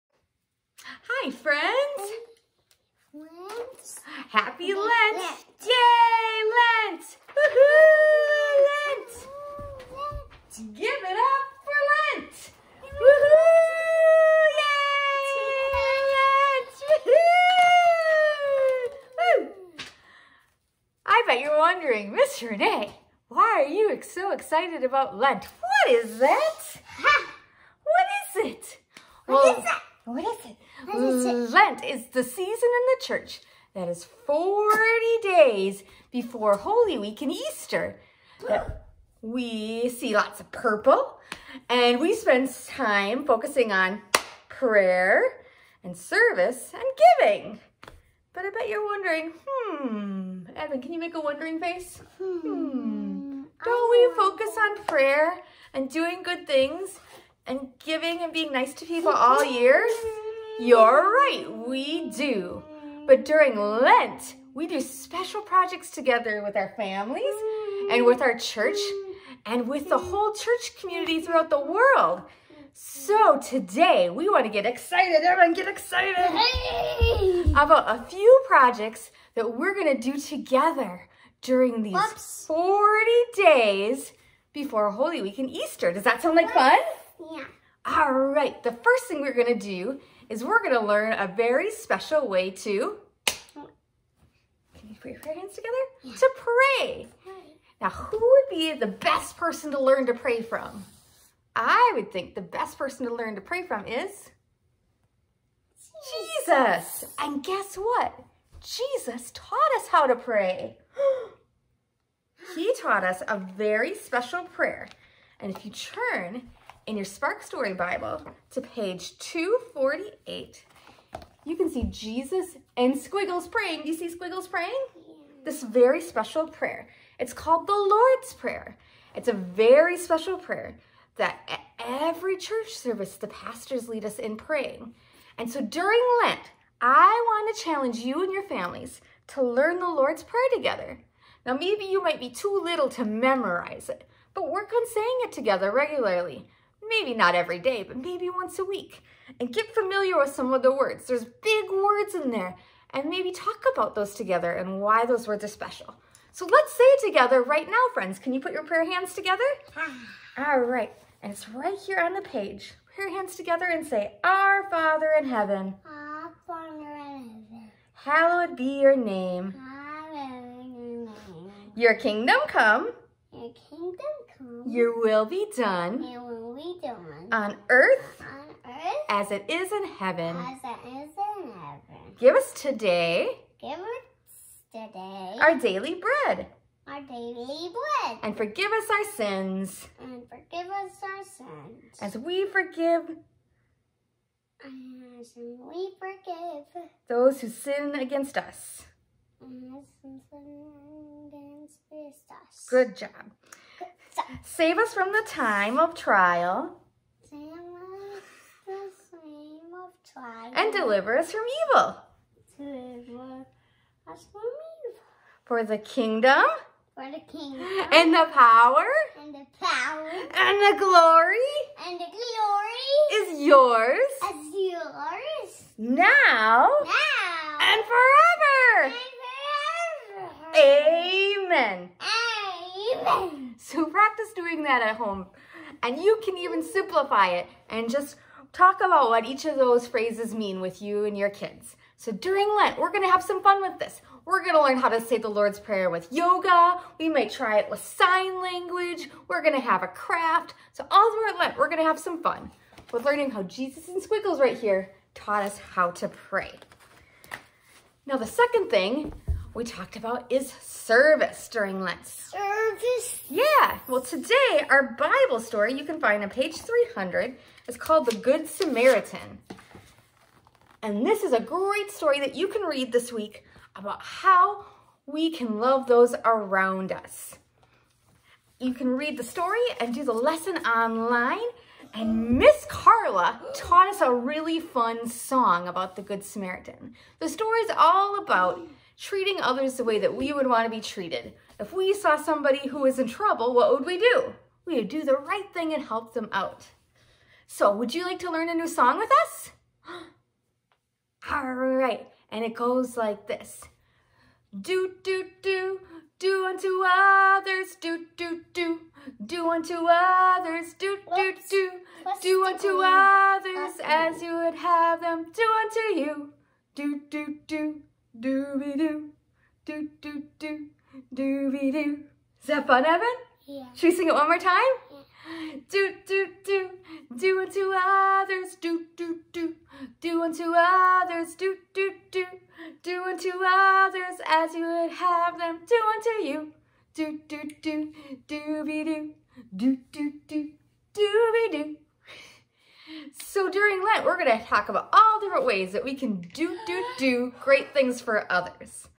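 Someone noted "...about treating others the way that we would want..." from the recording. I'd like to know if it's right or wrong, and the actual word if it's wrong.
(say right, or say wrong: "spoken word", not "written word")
right.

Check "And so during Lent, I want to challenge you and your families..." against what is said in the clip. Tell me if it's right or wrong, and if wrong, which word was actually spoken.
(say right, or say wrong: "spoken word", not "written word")
right.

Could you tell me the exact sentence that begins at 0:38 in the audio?
That we see lots of purple and we spend time focusing on prayer and service and giving.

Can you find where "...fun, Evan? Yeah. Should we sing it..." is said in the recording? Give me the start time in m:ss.
5:22.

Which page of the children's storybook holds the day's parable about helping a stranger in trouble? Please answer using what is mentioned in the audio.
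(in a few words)
300.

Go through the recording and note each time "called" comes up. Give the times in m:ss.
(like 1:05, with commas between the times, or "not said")
2:07, 4:27.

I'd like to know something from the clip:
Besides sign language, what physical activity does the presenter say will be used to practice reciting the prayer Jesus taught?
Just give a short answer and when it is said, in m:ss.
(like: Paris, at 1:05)
Yoga, at 4:06.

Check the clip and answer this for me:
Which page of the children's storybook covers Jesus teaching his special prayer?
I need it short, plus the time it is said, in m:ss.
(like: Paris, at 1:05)
248, at 1:58.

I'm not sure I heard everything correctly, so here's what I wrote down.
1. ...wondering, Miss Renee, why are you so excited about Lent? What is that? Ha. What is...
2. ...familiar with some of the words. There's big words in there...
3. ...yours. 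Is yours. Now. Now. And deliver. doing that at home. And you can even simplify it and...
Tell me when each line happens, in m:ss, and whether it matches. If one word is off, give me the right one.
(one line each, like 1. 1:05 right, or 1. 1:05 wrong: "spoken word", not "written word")
1. 0:21 right
2. 2:29 right
3. 3:43 wrong: "forever", not "deliver".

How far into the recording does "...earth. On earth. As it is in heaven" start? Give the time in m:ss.
2:57.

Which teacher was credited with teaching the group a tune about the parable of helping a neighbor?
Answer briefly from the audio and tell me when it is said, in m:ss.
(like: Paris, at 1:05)
Miss Carla, at 4:42.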